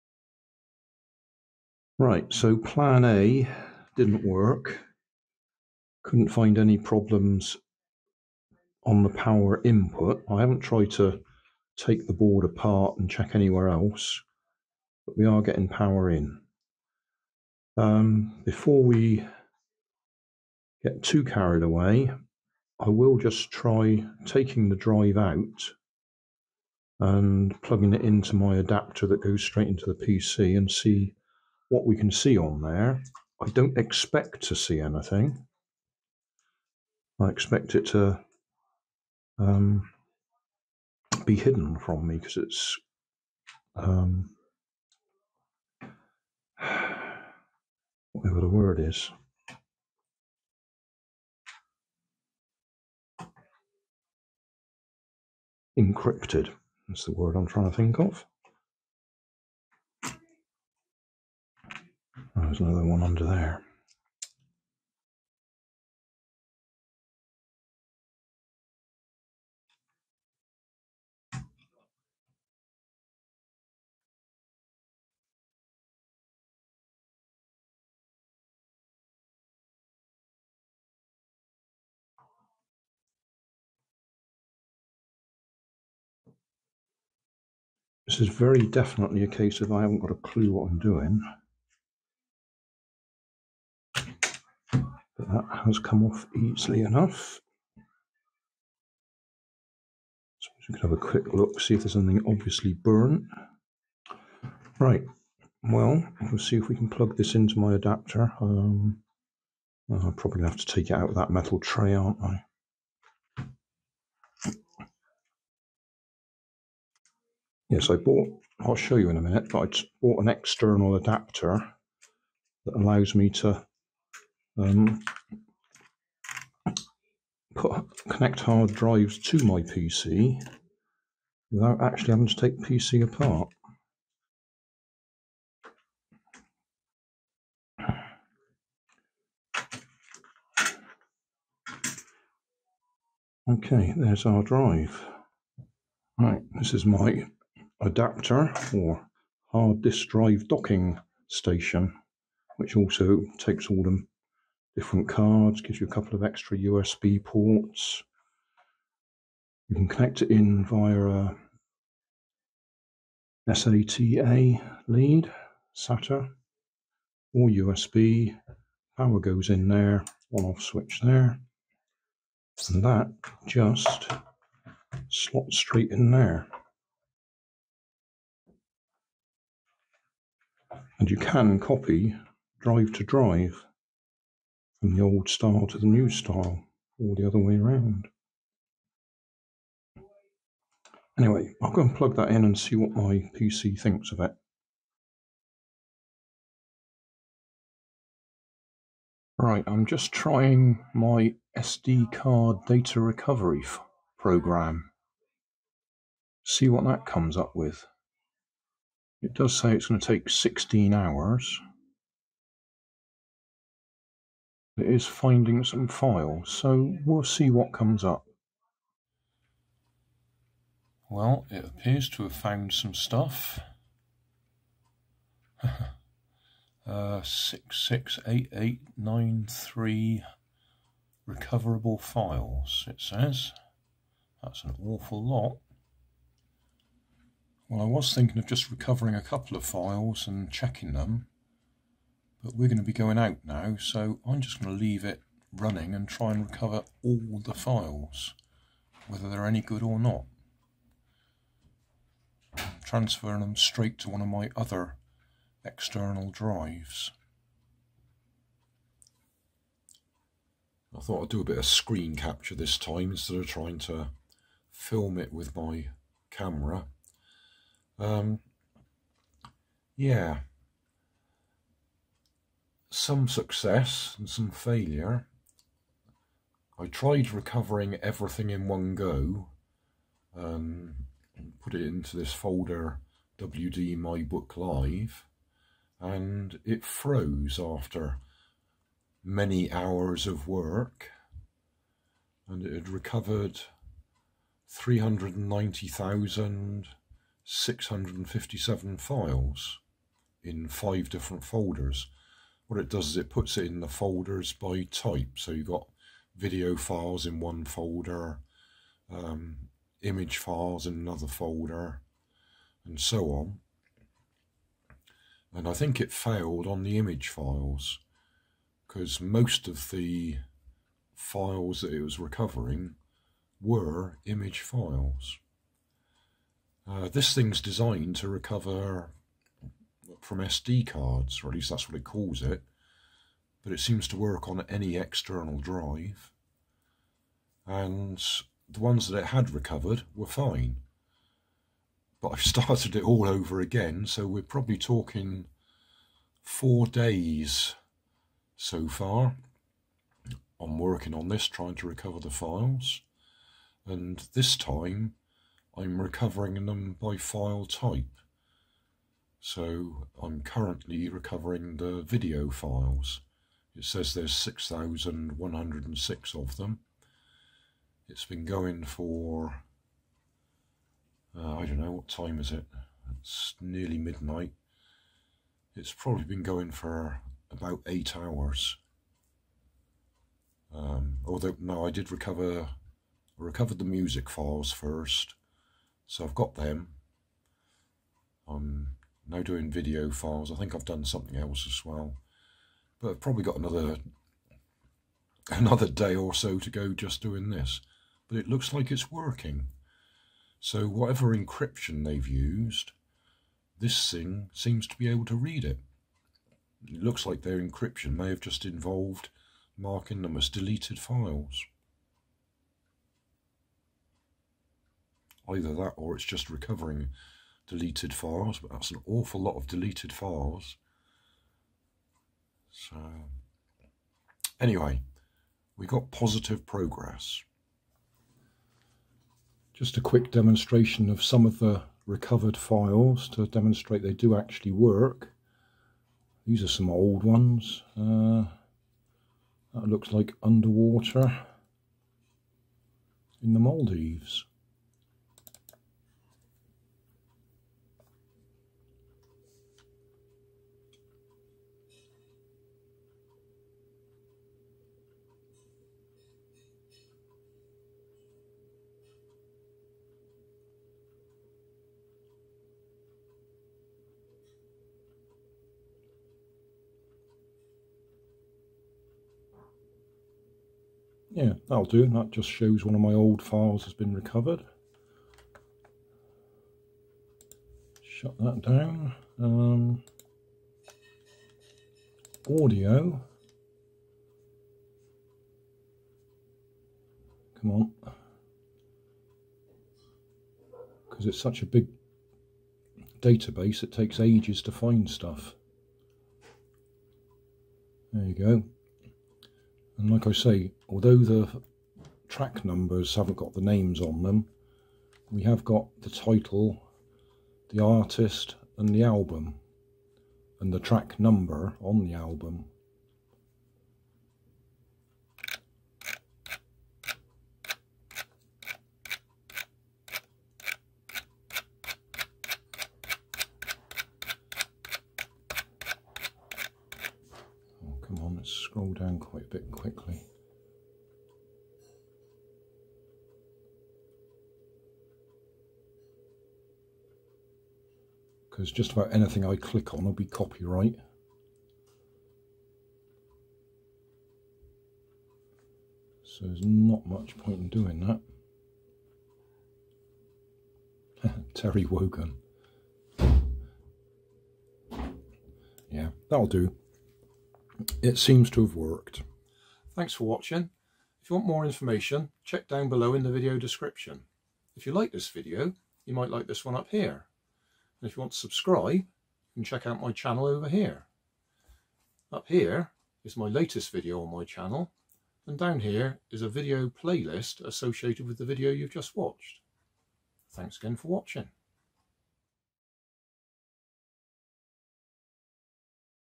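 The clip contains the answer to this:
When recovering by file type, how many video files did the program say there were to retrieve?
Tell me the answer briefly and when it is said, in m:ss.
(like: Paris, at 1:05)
6,106, at 6:04.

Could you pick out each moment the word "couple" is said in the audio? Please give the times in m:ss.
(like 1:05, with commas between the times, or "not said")
2:35, 3:59.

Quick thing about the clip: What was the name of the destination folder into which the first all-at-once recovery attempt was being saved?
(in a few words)
WD My Book Live.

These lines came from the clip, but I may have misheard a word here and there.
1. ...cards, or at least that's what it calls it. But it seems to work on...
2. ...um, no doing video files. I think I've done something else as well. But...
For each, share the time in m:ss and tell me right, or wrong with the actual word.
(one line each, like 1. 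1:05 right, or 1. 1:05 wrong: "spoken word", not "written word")
1. 5:30 right
2. 6:28 right.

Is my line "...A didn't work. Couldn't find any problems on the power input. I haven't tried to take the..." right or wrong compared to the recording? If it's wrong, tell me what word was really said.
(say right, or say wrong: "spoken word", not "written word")
right.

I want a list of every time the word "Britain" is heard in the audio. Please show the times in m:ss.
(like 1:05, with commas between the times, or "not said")
not said.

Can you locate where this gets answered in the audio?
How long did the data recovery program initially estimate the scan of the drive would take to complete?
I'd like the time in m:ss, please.
3:30.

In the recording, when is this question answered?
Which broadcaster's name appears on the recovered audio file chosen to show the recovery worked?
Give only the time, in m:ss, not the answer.
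9:11.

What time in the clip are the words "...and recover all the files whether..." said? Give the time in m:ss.
4:06.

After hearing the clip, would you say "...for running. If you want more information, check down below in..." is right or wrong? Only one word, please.
wrong.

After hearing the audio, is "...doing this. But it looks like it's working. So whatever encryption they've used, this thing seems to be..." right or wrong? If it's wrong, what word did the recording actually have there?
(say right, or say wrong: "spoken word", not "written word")
right.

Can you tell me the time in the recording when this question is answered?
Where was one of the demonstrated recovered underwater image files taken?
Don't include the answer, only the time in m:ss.
7:23.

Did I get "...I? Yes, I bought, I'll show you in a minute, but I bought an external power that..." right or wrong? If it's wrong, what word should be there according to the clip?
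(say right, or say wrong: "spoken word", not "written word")
wrong: "adapter", not "power".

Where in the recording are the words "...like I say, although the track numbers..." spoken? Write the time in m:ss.
8:20.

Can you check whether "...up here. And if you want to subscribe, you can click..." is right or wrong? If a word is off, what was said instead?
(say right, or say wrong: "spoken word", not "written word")
wrong: "check", not "click".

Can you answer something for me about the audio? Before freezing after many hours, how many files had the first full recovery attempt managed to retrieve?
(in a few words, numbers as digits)
390,657.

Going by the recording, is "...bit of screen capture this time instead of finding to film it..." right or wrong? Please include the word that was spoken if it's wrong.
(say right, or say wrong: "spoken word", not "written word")
wrong: "trying", not "finding".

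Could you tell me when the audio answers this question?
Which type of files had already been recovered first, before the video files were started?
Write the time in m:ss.
6:23.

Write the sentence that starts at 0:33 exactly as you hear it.
I don't expect to see anything.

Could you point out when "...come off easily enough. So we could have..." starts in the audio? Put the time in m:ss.
1:35.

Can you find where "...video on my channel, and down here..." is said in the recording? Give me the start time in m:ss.
9:33.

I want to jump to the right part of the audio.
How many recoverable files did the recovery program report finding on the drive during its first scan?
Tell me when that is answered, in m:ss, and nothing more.
3:47.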